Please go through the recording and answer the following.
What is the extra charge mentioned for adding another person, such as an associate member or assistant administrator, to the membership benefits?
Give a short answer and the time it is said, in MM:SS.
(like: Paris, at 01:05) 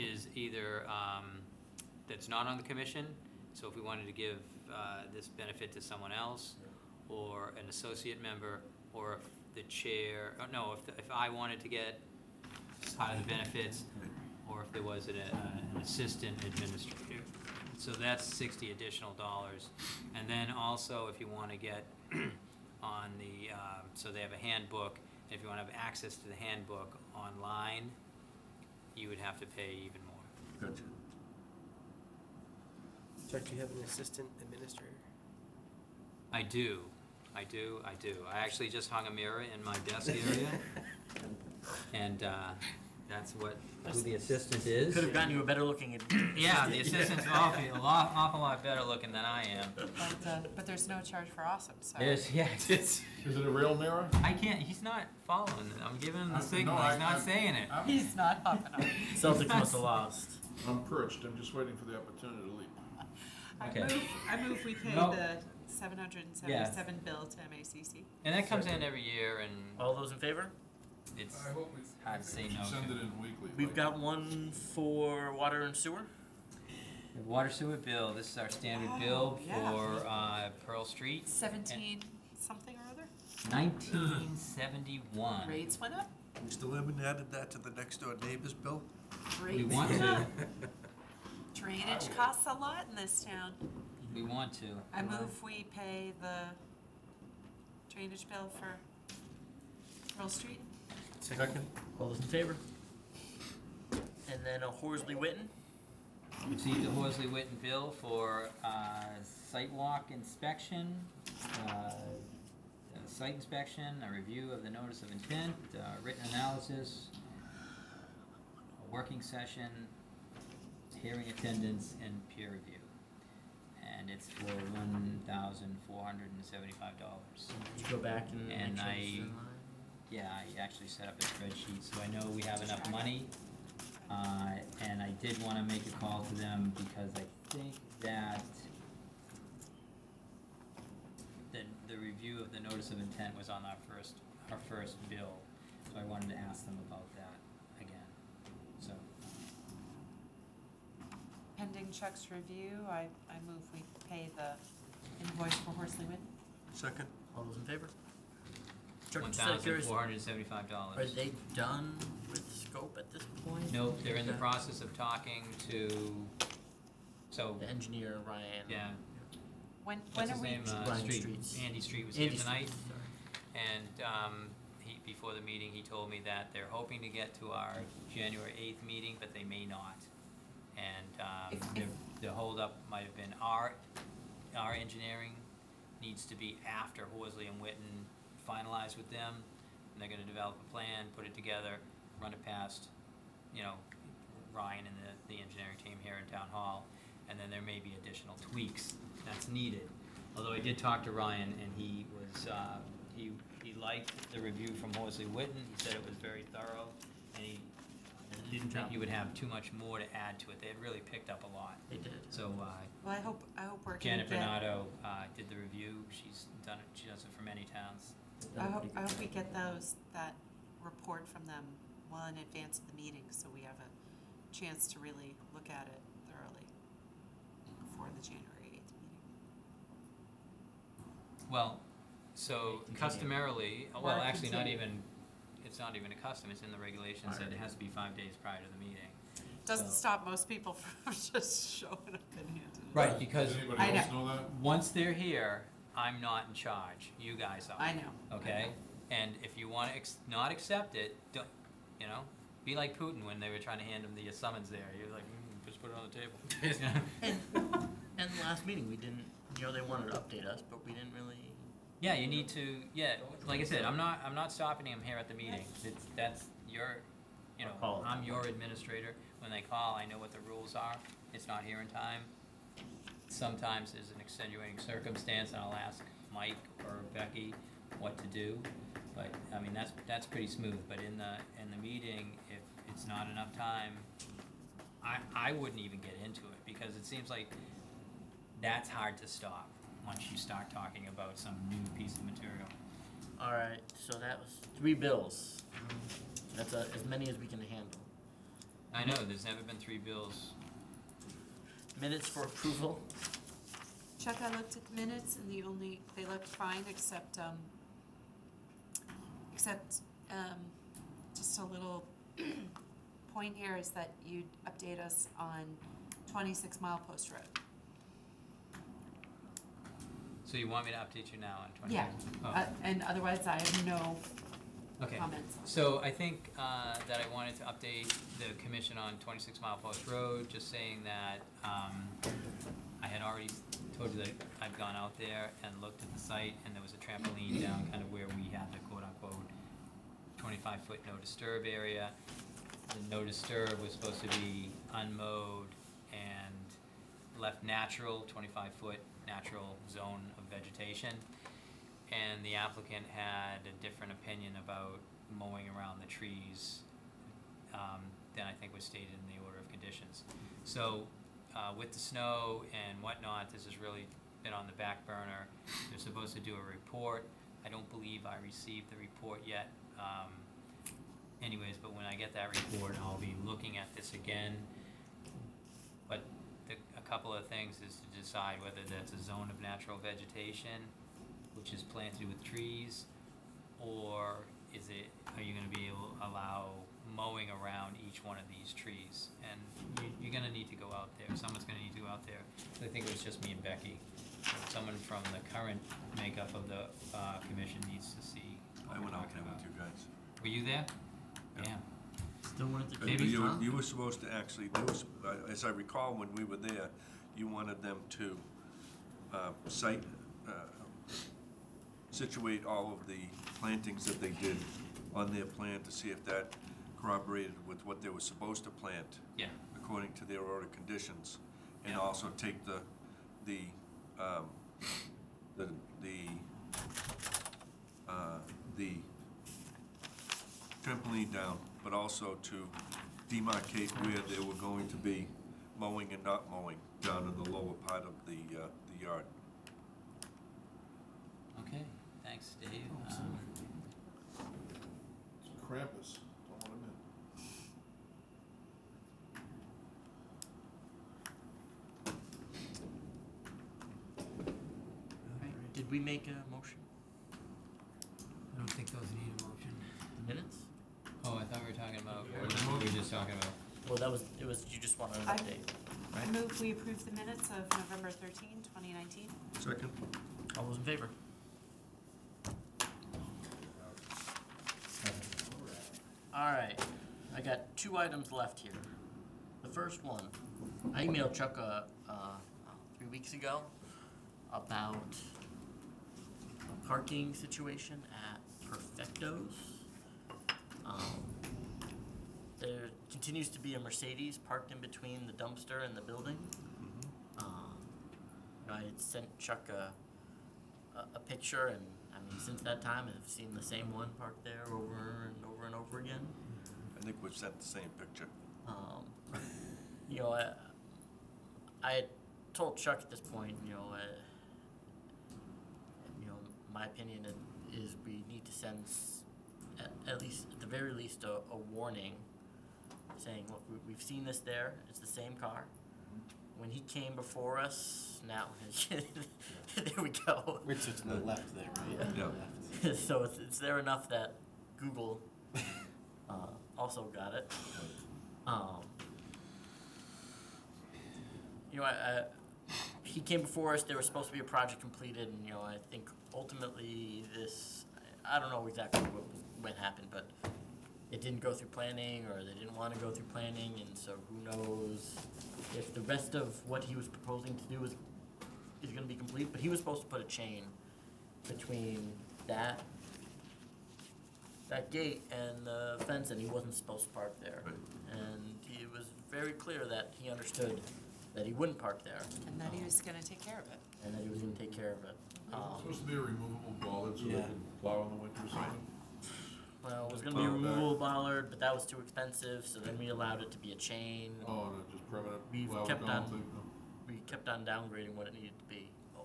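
$60, at 00:18.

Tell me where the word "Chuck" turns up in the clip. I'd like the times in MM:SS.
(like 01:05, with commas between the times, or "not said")
02:31, 05:04, 08:01, 08:19, 08:32.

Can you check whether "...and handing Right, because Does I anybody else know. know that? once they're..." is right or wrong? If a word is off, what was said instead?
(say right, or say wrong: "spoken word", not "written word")
right.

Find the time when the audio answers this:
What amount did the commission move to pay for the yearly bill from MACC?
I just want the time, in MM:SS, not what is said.
01:05.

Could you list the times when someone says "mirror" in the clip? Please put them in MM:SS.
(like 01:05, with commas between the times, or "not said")
00:39, 00:53.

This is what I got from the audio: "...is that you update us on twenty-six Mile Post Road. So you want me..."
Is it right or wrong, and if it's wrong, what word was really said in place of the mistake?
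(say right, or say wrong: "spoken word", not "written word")
right.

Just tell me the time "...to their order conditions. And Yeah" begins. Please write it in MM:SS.
07:00.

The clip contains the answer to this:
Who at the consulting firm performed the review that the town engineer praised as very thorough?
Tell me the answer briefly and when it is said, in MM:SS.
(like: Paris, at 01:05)
Janet Bernardo, at 03:33.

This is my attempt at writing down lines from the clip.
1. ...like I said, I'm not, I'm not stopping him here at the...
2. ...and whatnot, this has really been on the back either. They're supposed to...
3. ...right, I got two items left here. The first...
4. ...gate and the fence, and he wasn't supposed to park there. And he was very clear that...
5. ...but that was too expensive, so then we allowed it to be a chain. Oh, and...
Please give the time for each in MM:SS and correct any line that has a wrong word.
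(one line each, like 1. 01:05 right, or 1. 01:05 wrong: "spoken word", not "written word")
1. 04:23 right
2. 06:02 wrong: "burner", not "either"
3. 07:56 right
4. 09:24 right
5. 09:41 right.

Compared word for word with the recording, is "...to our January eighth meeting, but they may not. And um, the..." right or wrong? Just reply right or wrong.
right.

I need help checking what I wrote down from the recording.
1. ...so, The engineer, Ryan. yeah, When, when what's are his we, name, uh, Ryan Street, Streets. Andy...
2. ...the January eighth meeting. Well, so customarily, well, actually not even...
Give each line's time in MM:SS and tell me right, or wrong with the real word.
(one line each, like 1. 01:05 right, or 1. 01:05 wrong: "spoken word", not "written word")
1. 02:47 right
2. 03:48 right.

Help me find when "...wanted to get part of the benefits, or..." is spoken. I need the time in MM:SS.
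00:11.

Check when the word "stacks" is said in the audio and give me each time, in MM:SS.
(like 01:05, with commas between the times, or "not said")
not said.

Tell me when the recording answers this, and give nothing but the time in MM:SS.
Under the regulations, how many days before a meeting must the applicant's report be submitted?
03:57.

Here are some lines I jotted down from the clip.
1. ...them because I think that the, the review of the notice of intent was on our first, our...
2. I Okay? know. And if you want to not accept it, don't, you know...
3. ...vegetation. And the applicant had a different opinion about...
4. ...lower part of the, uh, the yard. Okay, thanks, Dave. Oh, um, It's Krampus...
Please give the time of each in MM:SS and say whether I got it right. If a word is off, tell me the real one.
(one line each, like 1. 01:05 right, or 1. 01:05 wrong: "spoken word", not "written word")
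1. 02:16 right
2. 04:08 right
3. 05:50 right
4. 07:17 right.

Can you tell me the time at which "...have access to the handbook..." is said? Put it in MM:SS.
00:25.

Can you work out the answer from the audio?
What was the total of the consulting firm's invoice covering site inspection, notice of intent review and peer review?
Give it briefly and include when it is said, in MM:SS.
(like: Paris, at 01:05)
$1,475, at 02:04.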